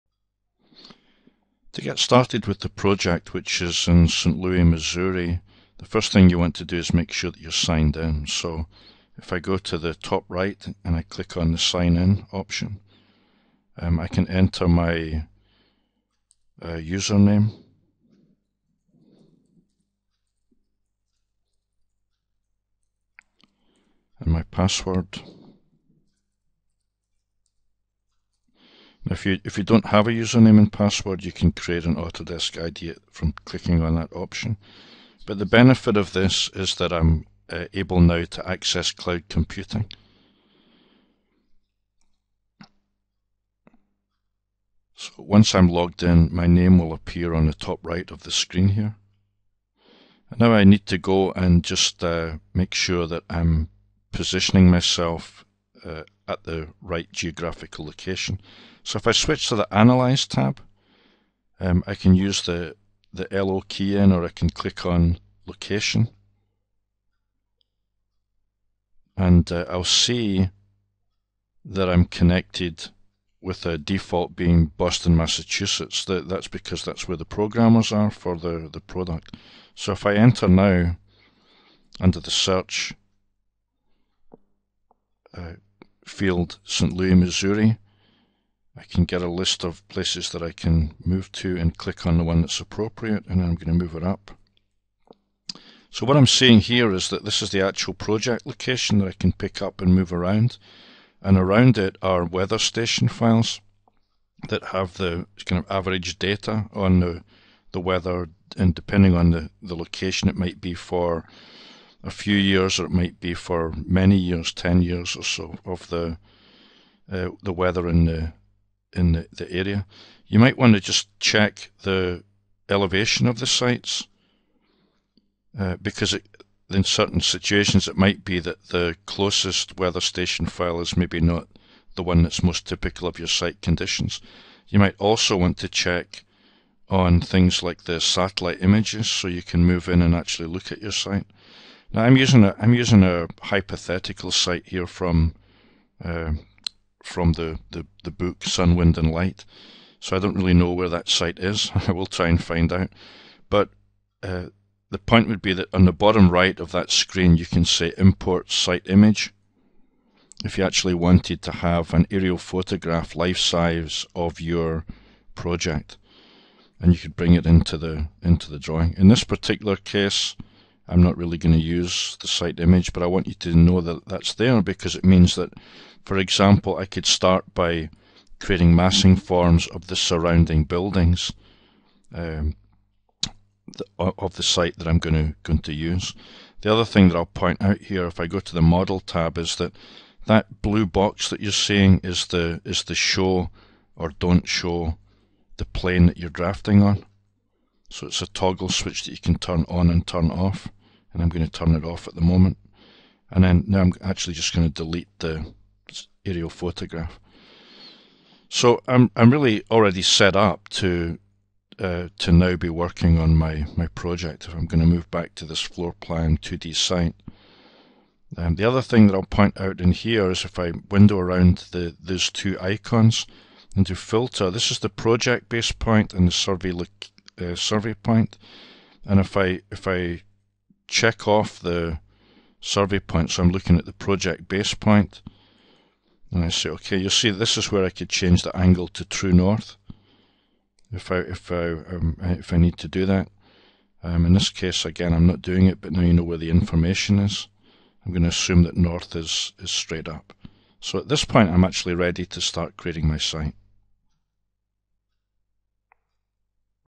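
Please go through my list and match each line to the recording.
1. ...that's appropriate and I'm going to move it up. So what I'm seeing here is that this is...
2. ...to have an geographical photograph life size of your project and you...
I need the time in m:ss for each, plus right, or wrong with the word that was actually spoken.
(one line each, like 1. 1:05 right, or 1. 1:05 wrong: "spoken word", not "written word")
1. 1:32 right
2. 2:41 wrong: "aerial", not "geographical".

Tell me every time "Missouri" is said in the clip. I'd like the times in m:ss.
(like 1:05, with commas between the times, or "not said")
0:04, 1:27.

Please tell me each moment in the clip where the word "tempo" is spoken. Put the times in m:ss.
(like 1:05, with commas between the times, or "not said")
not said.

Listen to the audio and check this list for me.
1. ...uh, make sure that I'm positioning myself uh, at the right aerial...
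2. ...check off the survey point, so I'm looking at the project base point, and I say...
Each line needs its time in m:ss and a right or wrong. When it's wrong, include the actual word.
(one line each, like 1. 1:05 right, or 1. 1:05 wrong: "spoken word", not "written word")
1. 0:52 wrong: "geographical", not "aerial"
2. 3:50 right.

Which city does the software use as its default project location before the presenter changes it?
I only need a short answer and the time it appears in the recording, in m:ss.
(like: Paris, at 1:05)
Boston, Massachusetts, at 1:14.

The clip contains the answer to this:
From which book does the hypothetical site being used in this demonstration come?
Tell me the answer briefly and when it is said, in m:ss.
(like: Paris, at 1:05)
Sun, Wind and Light, at 2:28.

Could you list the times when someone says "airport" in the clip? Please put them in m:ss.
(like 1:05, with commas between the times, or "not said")
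not said.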